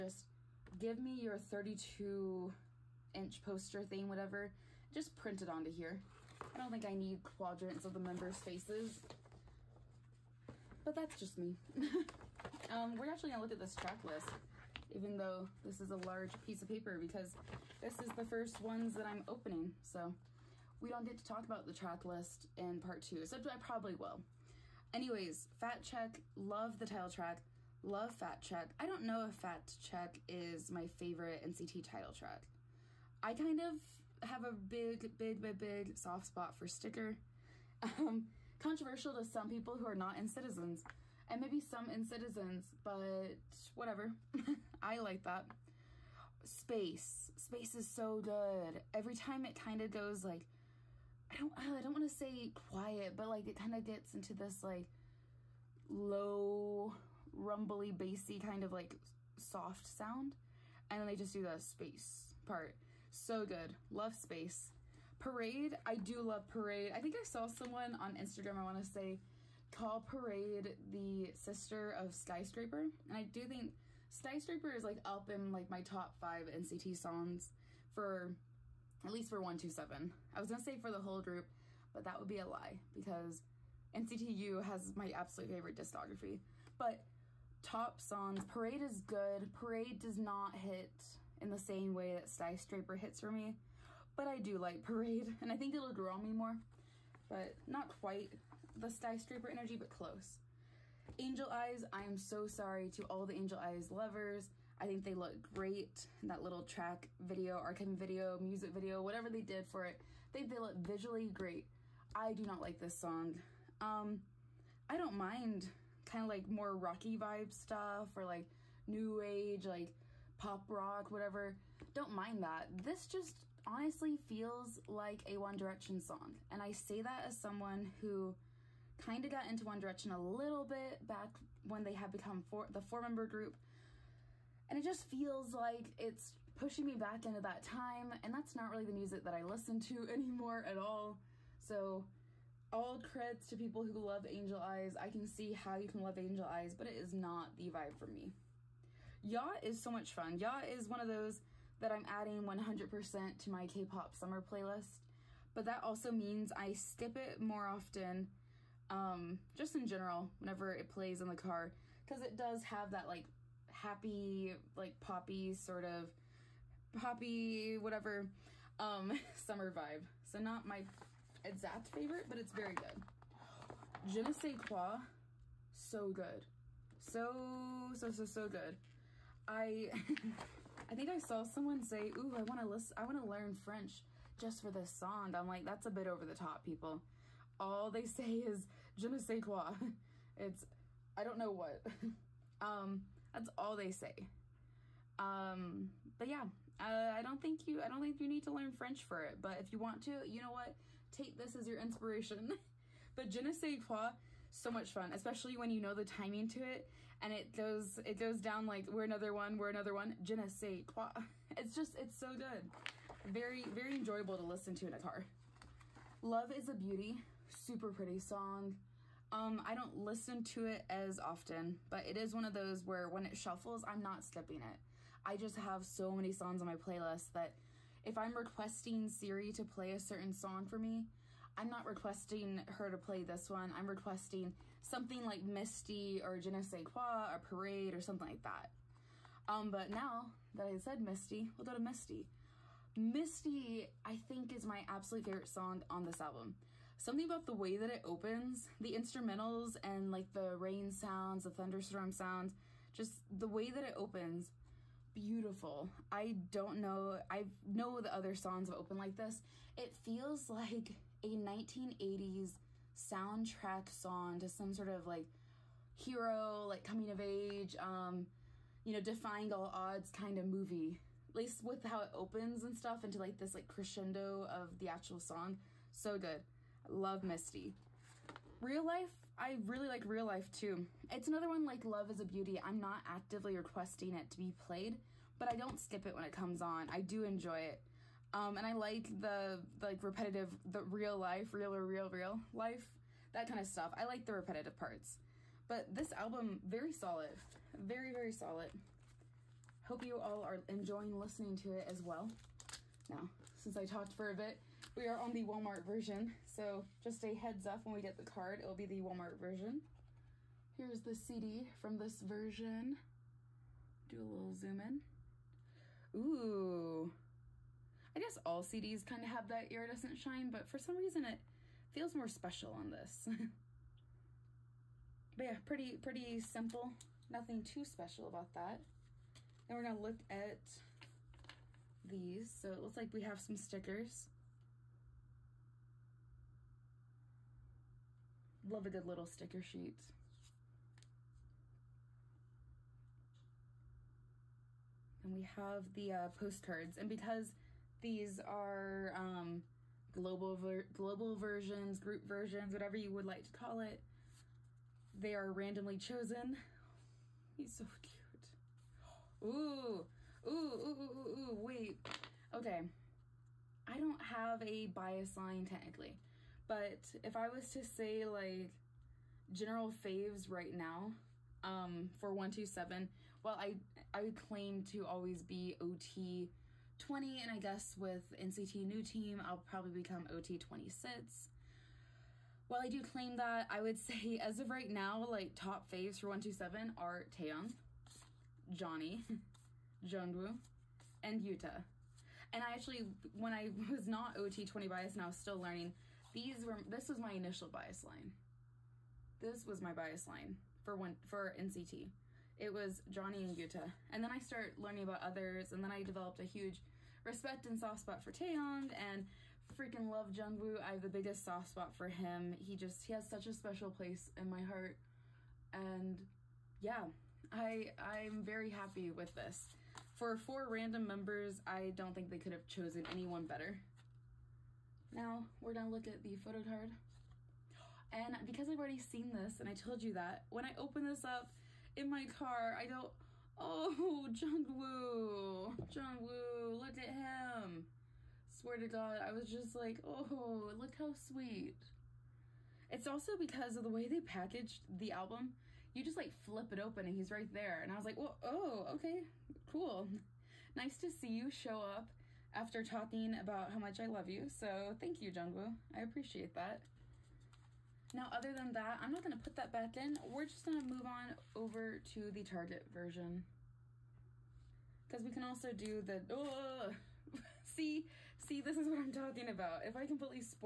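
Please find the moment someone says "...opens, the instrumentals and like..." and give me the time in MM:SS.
04:08.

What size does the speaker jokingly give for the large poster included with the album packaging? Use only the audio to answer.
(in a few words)
32 inch.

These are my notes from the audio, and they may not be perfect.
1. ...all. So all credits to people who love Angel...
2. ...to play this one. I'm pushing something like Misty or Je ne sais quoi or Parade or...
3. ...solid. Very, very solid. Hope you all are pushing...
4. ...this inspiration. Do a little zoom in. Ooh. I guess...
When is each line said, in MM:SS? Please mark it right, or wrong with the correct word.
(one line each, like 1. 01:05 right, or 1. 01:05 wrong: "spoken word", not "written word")
1. 02:20 right
2. 03:52 wrong: "requesting", not "pushing"
3. 04:56 wrong: "enjoying", not "pushing"
4. 05:11 wrong: "version", not "inspiration".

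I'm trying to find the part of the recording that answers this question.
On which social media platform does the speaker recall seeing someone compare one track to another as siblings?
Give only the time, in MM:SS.
01:08.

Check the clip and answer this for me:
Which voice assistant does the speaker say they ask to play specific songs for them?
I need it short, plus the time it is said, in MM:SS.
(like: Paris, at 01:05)
Siri, at 03:49.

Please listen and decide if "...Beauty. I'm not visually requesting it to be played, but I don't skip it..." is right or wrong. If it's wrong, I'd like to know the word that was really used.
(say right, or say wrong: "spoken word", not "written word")
wrong: "actively", not "visually".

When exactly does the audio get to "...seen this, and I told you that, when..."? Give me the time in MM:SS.
07:08.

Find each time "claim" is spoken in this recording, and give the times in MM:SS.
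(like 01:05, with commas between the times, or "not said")
06:14, 06:23.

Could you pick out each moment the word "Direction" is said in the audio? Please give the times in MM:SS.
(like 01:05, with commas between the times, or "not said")
02:05, 02:09.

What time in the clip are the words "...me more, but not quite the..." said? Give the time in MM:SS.
01:36.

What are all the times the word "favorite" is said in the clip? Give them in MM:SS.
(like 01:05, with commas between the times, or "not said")
00:30, 01:25, 02:51, 04:05.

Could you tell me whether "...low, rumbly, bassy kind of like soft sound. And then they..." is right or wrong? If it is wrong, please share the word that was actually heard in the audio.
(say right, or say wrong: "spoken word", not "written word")
right.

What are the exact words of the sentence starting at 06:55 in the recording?
And yeah, I, I'm very happy with this.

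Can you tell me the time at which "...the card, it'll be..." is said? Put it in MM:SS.
05:08.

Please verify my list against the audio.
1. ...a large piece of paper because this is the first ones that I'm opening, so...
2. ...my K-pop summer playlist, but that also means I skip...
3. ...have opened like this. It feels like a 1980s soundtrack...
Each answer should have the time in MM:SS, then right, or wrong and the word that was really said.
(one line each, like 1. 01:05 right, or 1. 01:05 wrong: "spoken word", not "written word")
1. 00:15 right
2. 02:33 right
3. 04:18 right.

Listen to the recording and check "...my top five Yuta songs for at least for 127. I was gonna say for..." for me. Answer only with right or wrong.
wrong.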